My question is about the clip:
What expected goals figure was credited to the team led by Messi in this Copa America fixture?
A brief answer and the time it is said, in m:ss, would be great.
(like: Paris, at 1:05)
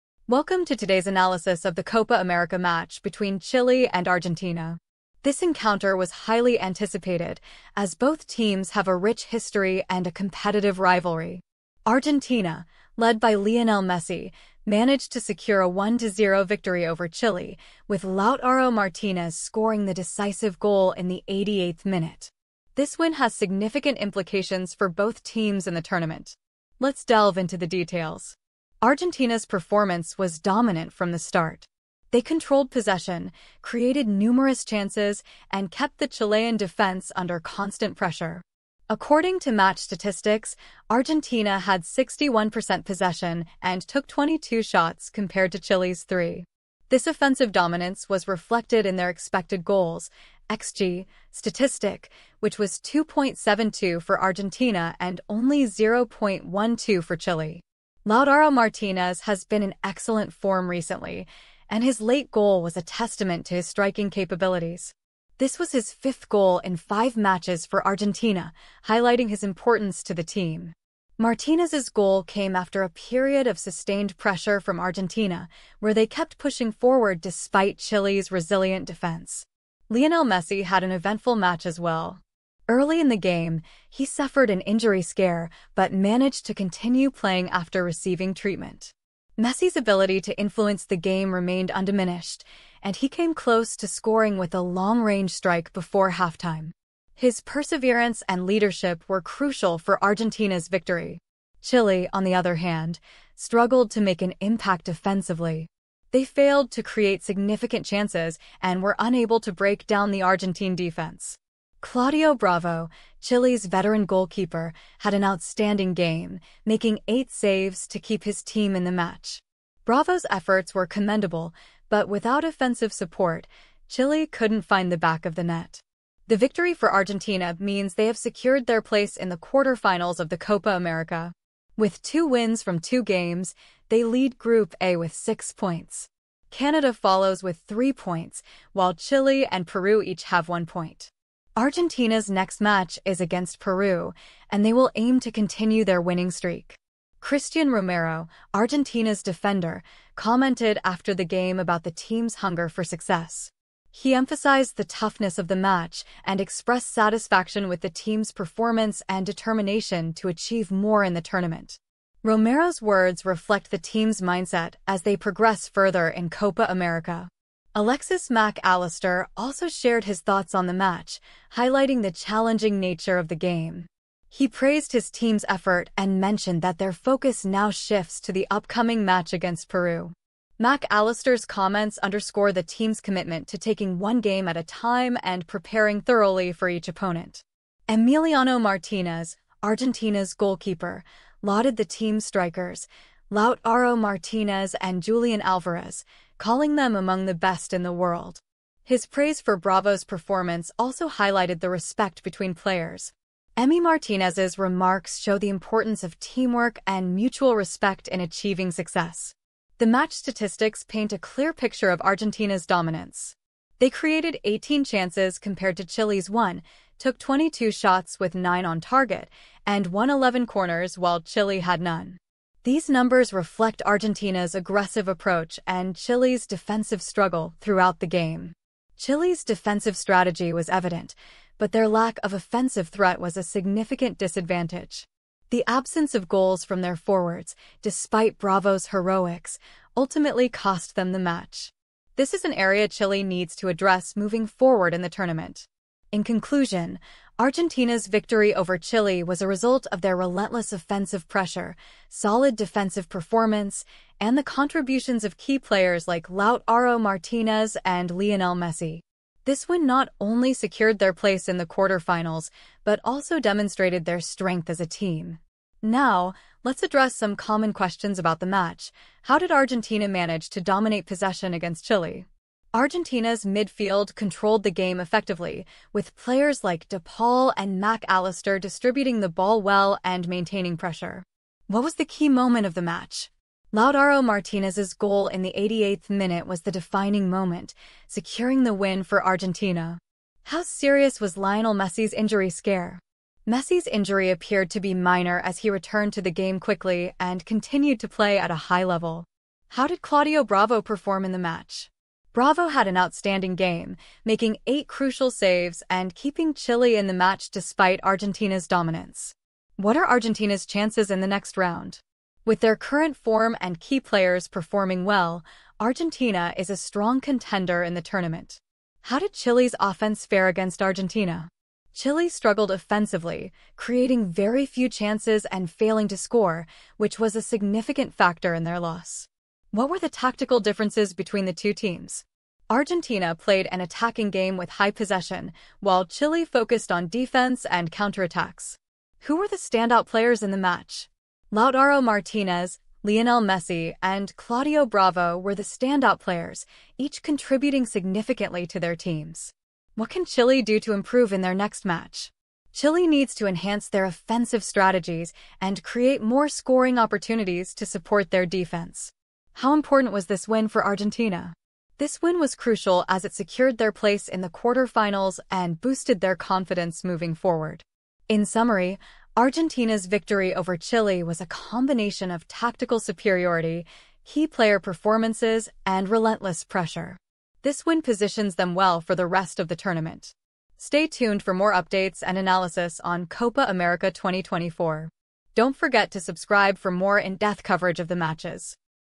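2.72, at 0:52.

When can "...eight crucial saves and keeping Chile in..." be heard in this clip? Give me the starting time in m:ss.
5:04.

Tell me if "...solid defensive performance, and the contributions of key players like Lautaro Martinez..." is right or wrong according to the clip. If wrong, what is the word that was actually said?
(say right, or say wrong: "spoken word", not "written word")
right.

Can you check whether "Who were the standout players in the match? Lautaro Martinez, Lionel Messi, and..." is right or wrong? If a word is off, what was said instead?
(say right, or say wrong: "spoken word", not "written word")
right.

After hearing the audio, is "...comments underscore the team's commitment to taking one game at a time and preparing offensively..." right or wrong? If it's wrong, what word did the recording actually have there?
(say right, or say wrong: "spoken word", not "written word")
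wrong: "thoroughly", not "offensively".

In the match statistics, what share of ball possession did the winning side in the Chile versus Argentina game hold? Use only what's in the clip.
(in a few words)
61%.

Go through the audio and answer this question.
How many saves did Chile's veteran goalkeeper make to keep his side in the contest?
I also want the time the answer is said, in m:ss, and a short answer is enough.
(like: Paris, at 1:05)
8, at 1:57.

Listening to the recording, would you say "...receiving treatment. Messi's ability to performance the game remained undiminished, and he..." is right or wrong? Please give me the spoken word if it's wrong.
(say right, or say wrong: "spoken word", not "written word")
wrong: "influence", not "performance".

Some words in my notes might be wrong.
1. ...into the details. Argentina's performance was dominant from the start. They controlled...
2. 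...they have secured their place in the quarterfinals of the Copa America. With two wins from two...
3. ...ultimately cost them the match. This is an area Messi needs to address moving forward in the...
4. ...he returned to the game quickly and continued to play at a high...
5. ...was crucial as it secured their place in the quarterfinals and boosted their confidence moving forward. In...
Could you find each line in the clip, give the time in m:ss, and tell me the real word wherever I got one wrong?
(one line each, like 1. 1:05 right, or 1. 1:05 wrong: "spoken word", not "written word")
1. 0:27 right
2. 2:07 right
3. 3:59 wrong: "Chile", not "Messi"
4. 4:55 right
5. 6:02 right.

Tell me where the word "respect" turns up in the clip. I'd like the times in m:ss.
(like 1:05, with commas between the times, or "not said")
3:21, 3:27.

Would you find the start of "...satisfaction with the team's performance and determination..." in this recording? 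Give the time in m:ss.
2:36.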